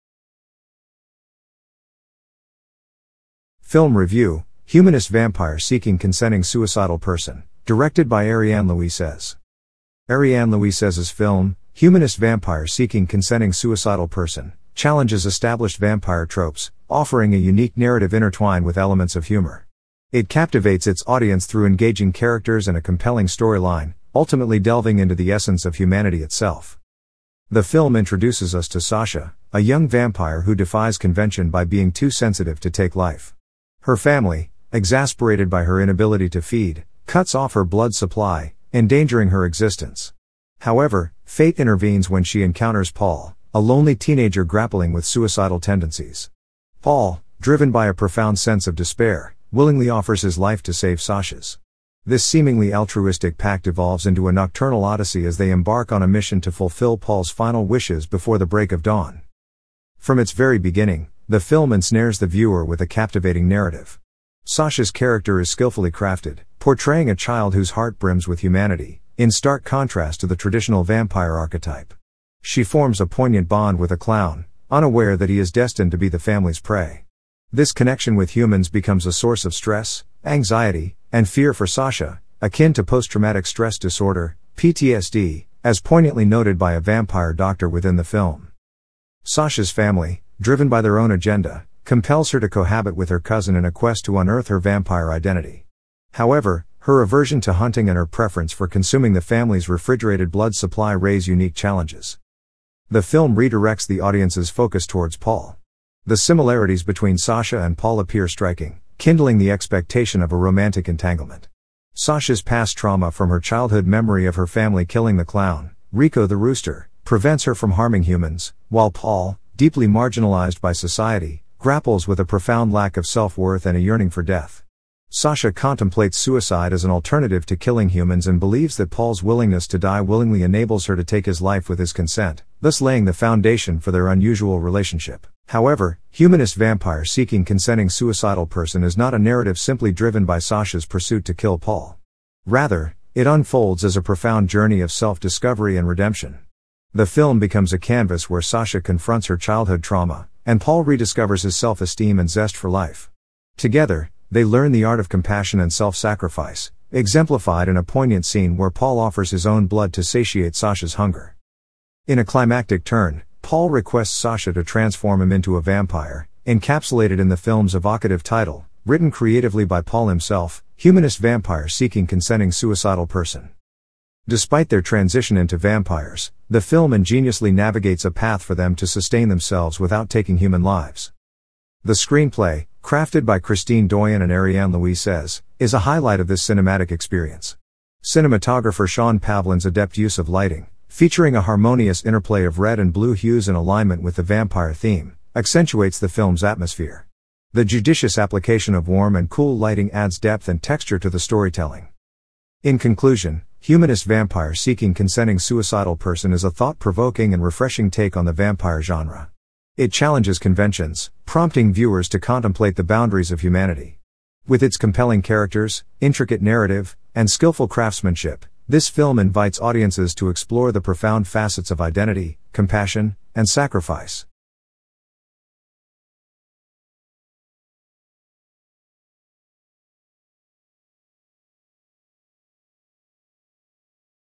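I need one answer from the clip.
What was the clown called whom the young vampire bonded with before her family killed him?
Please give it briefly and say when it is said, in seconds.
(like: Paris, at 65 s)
Rico the rooster, at 115 s.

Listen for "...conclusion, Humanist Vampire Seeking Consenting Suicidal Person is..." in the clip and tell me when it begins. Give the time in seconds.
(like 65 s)
202 s.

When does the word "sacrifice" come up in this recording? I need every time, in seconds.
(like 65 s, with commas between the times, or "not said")
155 s, 223 s.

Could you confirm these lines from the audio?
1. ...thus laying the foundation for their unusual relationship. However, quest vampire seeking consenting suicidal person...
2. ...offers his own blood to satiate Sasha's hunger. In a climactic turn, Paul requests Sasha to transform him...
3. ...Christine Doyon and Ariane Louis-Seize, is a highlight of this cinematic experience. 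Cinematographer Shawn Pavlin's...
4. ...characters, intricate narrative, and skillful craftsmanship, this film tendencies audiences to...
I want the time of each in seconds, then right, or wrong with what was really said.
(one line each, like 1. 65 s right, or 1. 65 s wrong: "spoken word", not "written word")
1. 132 s wrong: "humanist", not "quest"
2. 158 s right
3. 183 s right
4. 215 s wrong: "invites", not "tendencies".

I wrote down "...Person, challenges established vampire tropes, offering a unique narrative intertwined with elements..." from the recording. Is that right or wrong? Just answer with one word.
right.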